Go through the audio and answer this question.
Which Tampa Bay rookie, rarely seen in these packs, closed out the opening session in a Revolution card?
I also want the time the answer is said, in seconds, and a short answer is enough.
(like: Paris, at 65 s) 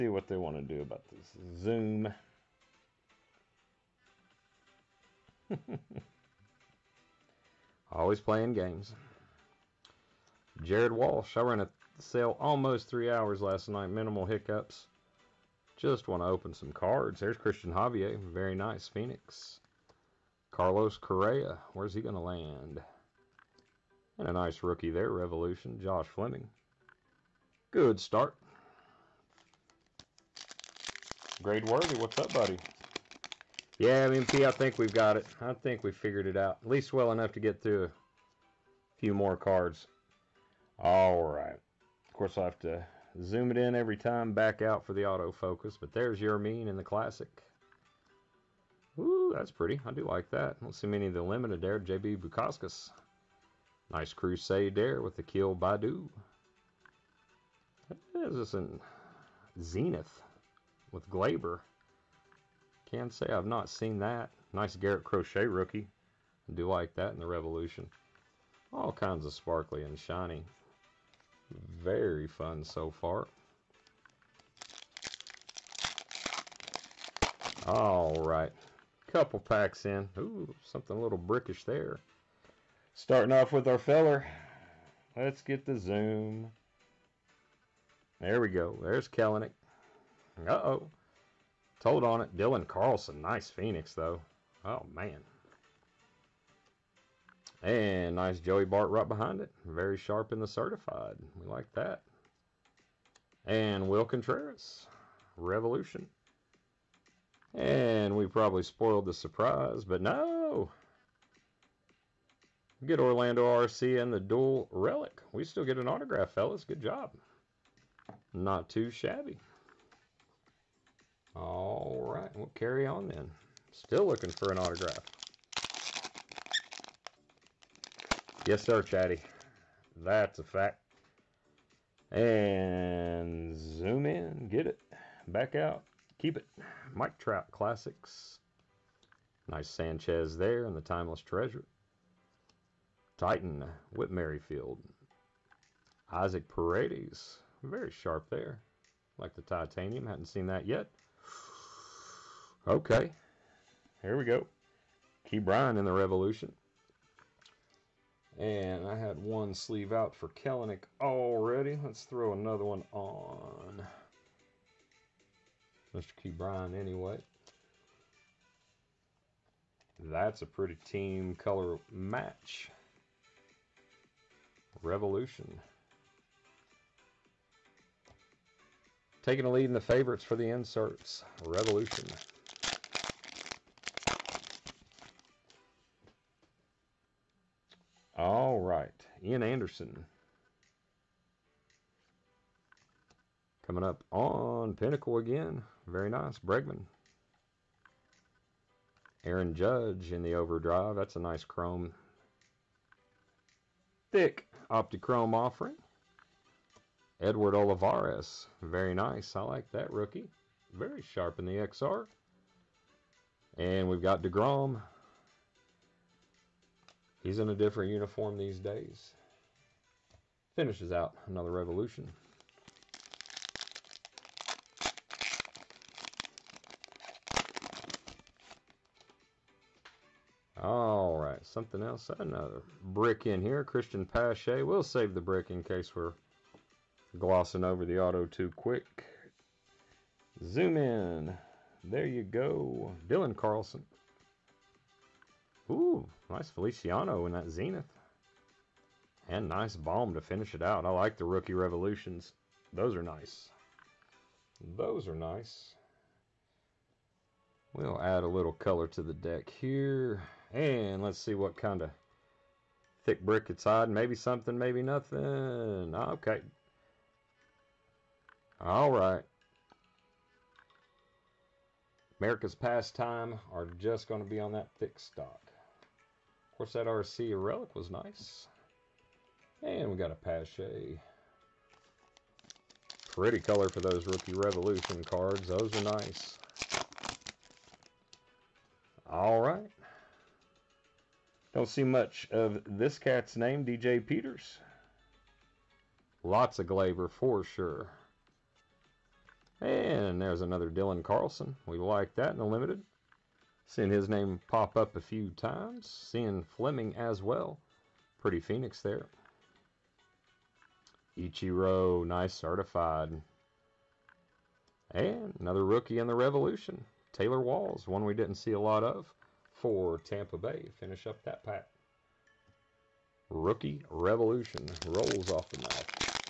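Taylor Walls, at 317 s.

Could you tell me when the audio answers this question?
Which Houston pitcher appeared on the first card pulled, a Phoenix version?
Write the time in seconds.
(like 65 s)
17 s.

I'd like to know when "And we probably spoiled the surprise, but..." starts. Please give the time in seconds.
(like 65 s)
107 s.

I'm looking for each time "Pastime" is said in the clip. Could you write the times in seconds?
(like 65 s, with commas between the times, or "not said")
272 s.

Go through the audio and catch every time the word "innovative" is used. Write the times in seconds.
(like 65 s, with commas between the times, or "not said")
not said.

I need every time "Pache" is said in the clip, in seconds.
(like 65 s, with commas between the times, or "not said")
234 s, 280 s.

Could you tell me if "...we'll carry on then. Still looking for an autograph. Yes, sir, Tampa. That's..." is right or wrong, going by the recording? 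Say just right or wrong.
wrong.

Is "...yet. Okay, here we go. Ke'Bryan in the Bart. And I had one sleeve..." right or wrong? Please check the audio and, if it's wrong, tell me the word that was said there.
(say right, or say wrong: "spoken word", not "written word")
wrong: "Revolution", not "Bart".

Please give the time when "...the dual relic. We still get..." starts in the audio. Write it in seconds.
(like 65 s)
114 s.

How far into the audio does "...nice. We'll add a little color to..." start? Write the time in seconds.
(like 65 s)
255 s.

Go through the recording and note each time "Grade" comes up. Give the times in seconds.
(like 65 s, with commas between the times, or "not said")
31 s.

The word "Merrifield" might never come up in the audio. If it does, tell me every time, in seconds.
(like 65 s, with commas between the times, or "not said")
144 s.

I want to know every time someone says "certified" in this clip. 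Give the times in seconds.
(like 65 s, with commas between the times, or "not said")
100 s, 312 s.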